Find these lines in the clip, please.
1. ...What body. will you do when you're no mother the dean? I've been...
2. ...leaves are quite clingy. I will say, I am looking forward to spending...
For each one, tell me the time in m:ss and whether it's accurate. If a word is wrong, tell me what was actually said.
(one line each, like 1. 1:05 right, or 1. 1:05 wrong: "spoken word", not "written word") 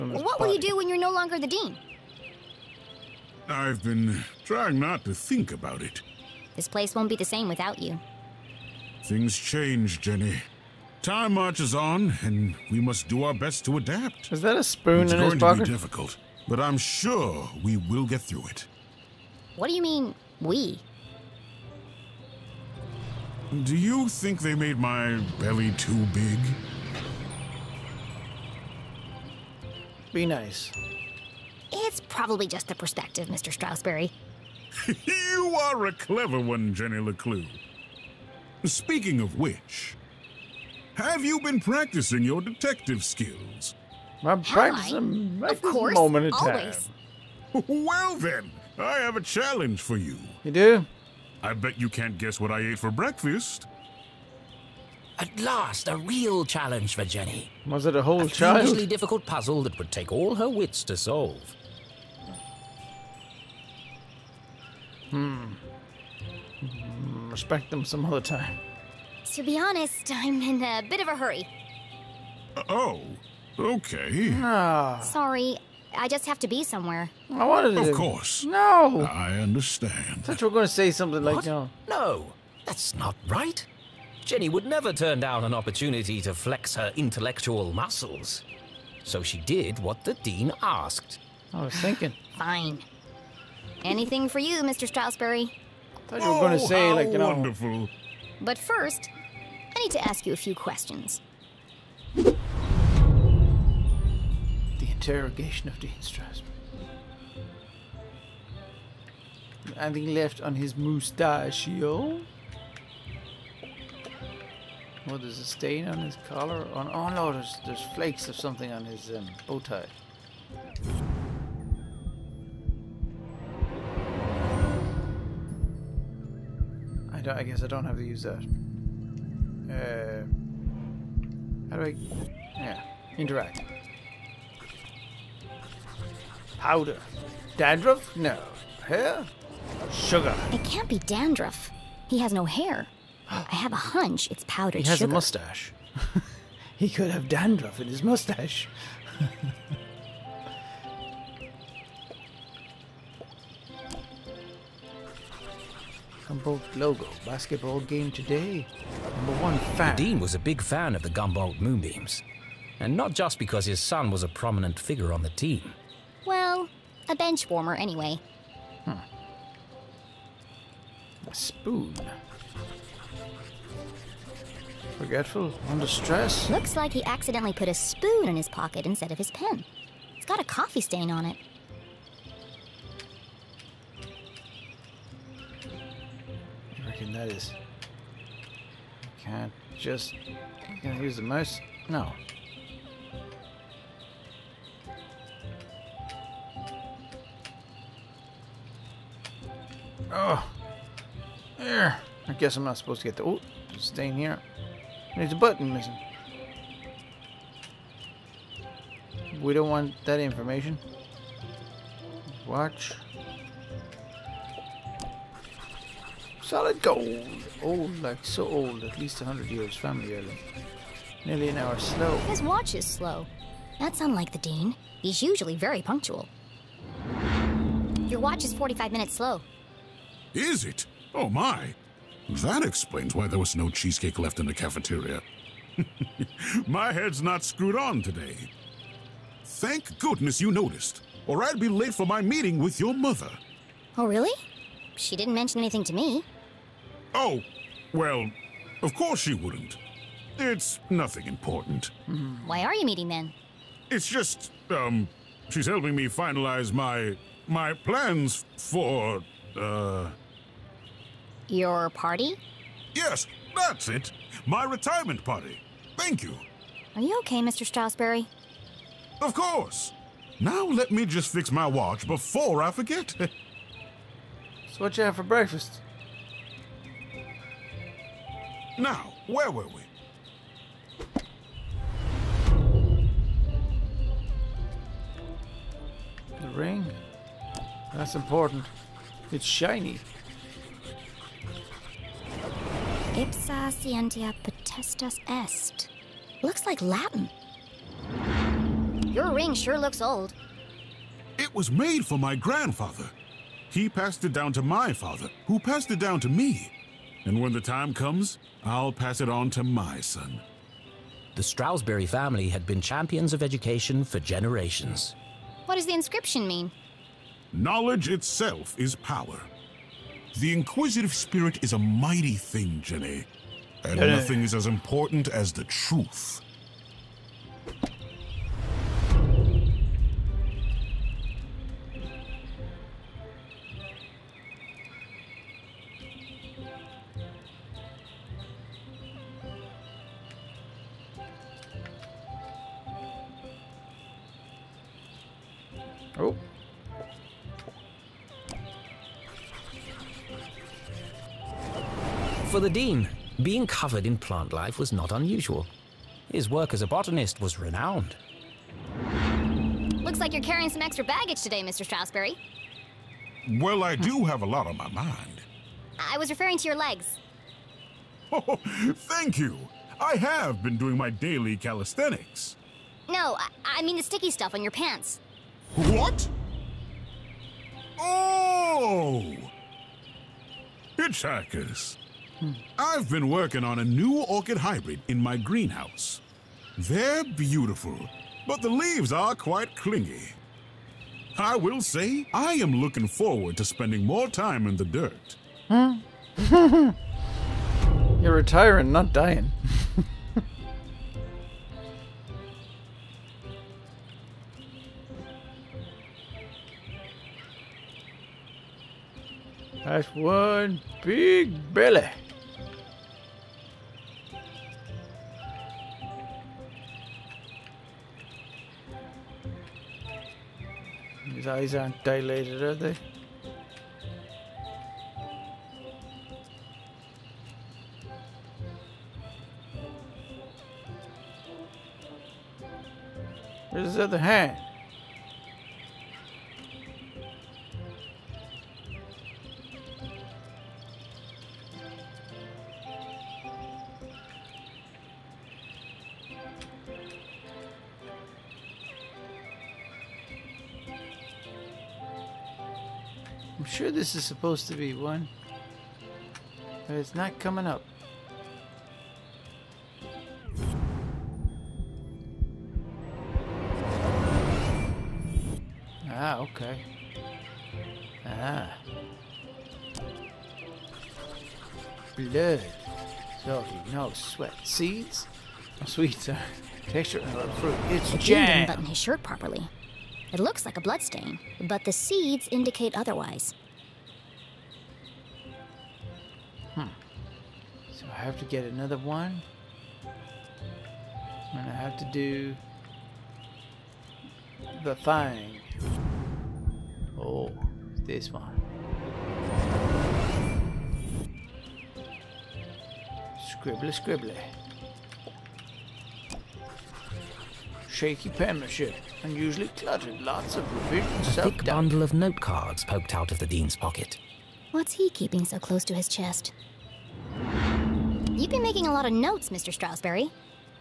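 1. 0:00 wrong: "longer", not "mother"
2. 6:28 right.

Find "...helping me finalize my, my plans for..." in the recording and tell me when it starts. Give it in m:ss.
4:15.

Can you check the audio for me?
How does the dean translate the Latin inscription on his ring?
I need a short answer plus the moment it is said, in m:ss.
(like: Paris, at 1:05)
Knowledge itself is power, at 5:17.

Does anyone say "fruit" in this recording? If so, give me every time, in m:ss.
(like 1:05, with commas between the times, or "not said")
7:57.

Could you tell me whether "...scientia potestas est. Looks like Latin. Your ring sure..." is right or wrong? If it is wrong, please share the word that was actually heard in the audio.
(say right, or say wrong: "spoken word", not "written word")
right.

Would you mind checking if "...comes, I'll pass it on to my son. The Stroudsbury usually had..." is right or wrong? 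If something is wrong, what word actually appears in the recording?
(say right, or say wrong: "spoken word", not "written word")
wrong: "family", not "usually".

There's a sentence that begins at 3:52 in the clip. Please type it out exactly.
That explains why there was no cheesecake left in the cafeteria.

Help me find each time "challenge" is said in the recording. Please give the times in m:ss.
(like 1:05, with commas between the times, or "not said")
0:49, 0:56.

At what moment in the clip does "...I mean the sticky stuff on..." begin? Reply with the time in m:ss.
6:13.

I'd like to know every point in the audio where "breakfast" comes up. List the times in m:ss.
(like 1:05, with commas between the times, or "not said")
0:52, 4:35.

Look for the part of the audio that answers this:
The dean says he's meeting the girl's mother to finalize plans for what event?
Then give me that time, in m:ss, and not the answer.
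4:24.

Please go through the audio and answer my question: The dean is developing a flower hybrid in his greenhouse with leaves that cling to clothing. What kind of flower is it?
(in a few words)
Orchid.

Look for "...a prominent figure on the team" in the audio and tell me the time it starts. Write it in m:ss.
2:44.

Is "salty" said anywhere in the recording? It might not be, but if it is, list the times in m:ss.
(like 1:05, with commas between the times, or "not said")
7:53.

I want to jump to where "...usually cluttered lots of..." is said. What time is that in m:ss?
8:29.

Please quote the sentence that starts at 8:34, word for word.
What's he keeping so close to his chest?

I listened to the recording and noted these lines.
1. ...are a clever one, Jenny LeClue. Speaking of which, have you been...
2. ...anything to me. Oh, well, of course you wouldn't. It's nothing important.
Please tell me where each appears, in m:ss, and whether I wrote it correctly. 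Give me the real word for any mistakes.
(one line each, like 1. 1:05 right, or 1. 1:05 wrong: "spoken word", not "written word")
1. 0:35 right
2. 4:05 right.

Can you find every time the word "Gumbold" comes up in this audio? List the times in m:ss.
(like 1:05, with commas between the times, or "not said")
2:36, 2:41.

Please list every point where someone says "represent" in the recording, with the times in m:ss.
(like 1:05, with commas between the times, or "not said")
not said.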